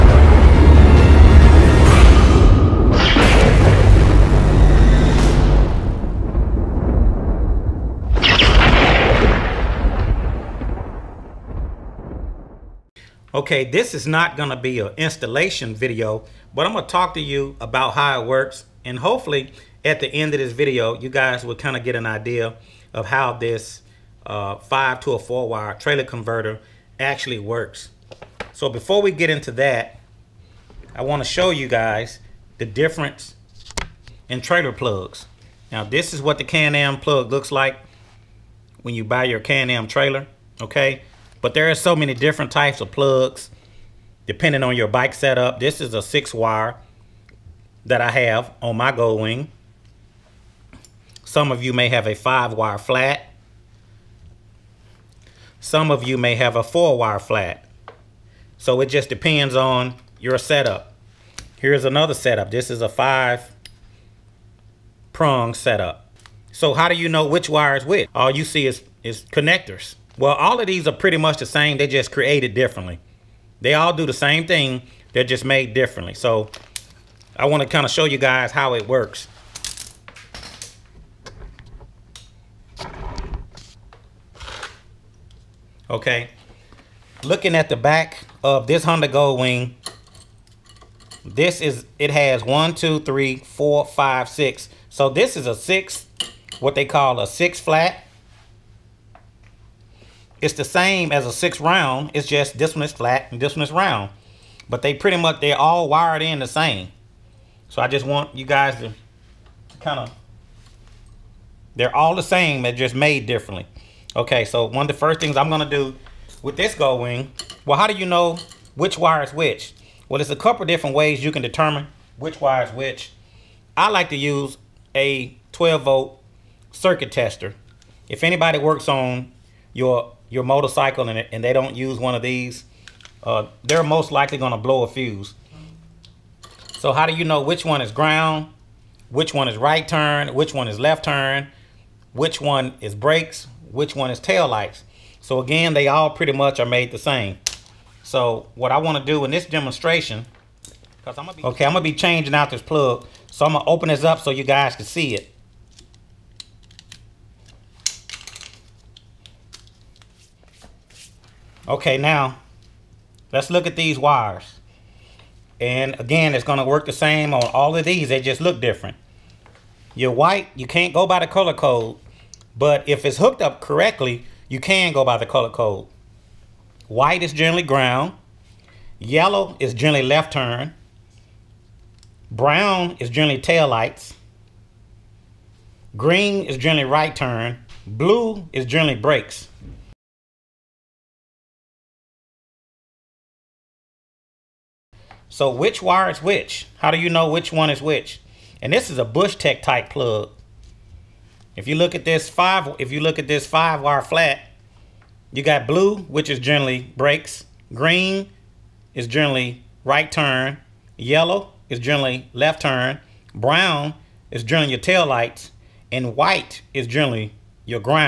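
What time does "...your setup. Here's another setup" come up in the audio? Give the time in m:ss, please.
1:00.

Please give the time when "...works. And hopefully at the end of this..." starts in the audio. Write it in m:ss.
0:18.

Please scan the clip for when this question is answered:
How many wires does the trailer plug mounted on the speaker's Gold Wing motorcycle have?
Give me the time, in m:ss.
0:46.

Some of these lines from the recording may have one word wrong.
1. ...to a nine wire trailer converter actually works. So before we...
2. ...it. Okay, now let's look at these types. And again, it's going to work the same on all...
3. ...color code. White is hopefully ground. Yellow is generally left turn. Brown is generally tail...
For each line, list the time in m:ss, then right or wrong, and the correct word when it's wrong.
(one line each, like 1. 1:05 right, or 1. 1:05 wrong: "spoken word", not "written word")
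1. 0:25 wrong: "four", not "nine"
2. 2:35 wrong: "wires", not "types"
3. 2:55 wrong: "generally", not "hopefully".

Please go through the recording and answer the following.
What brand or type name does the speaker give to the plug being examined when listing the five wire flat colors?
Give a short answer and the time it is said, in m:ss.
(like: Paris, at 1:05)
Bushtec, at 3:19.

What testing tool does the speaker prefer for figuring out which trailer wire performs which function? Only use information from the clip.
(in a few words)
12 volt circuit tester.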